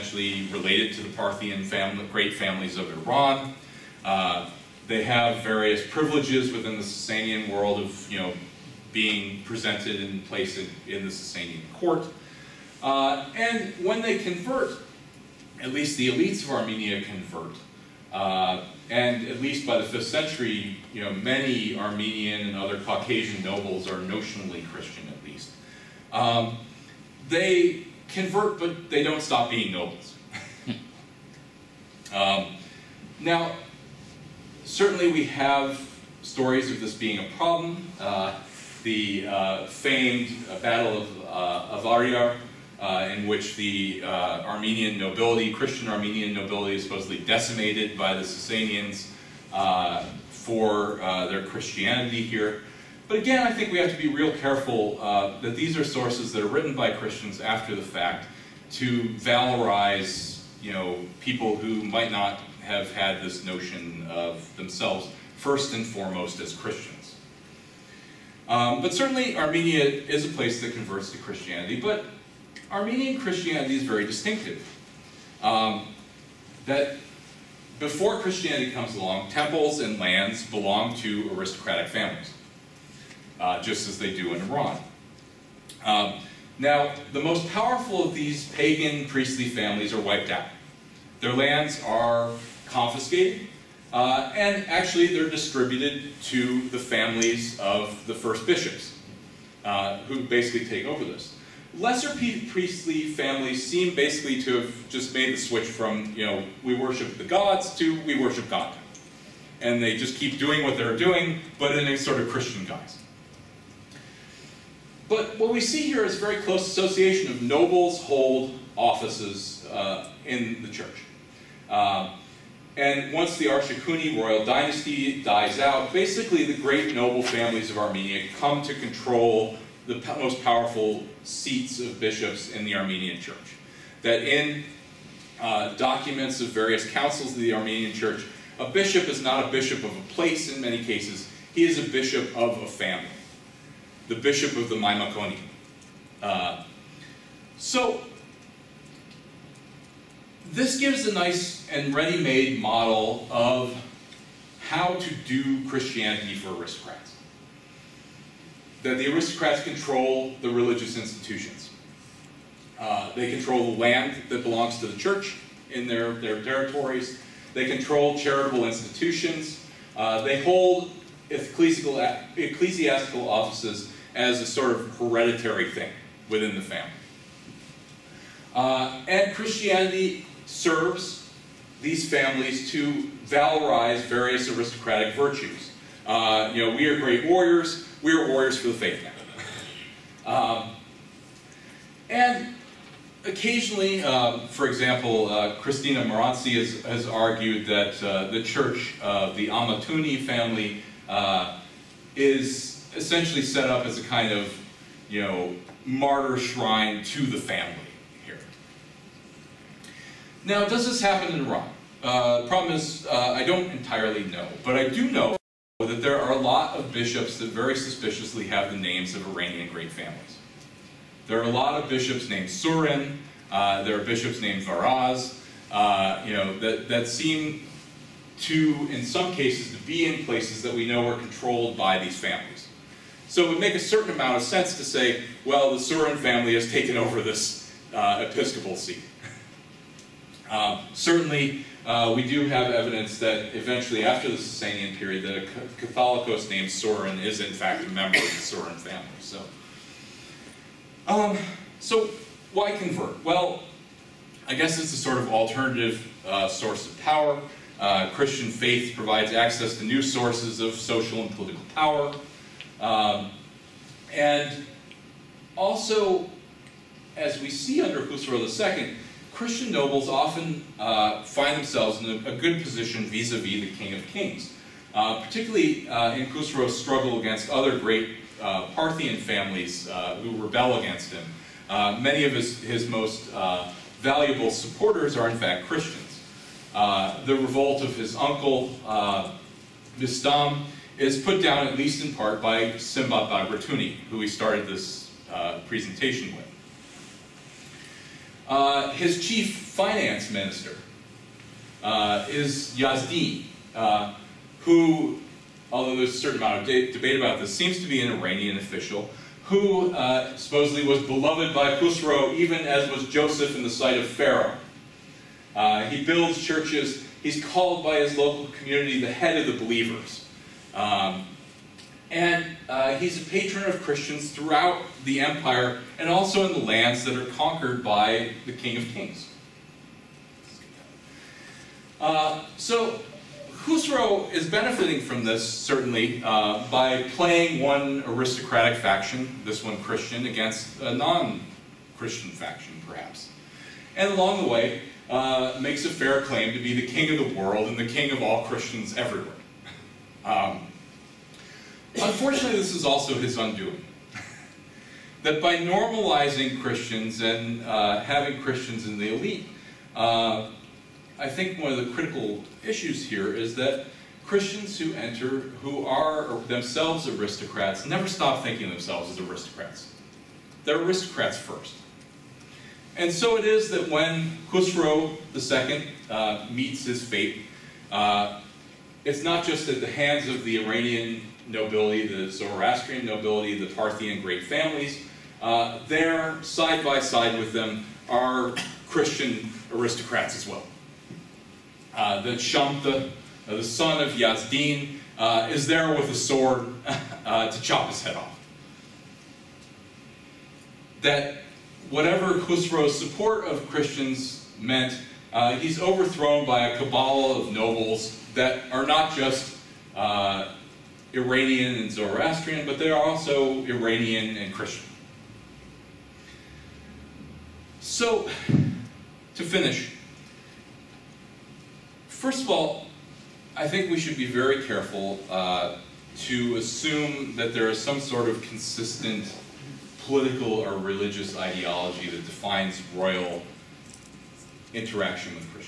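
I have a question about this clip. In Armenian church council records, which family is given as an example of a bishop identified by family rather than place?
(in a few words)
Maimakoni.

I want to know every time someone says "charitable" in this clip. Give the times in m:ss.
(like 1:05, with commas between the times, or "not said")
2:48.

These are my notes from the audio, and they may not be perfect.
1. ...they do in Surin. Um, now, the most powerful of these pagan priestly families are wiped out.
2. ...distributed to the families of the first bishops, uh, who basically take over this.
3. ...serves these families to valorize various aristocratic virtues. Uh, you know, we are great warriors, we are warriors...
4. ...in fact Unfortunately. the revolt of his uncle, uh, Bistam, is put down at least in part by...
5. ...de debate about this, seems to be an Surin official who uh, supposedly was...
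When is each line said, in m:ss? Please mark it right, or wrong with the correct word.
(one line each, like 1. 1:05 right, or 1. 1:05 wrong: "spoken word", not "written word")
1. 1:23 wrong: "Iran", not "Surin"
2. 1:35 right
3. 3:00 right
4. 4:45 wrong: "Christians", not "Unfortunately"
5. 5:06 wrong: "Iranian", not "Surin".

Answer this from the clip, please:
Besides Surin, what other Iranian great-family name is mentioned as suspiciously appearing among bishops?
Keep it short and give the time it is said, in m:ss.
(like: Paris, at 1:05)
Varaz, at 3:44.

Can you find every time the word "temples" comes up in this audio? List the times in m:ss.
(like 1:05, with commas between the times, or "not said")
1:19.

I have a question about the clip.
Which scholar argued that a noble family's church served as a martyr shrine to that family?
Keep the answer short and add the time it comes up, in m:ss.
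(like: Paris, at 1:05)
Christina Maranci, at 3:15.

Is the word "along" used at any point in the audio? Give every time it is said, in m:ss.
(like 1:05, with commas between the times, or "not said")
1:18, 5:44.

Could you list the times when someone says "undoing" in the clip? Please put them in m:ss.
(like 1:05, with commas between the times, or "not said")
5:53.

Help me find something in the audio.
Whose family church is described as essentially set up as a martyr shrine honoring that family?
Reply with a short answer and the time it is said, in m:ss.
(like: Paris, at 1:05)
Amatuni, at 3:19.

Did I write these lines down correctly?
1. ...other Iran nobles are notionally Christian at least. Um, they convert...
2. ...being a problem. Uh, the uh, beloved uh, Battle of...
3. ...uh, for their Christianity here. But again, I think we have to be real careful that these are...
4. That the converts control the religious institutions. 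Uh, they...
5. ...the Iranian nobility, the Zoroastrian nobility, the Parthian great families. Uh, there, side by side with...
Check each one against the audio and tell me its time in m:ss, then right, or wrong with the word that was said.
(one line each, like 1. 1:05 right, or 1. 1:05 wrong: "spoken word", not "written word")
1. 0:22 wrong: "Caucasian", not "Iran"
2. 0:36 wrong: "famed", not "beloved"
3. 0:49 right
4. 2:38 wrong: "aristocrats", not "converts"
5. 6:20 right.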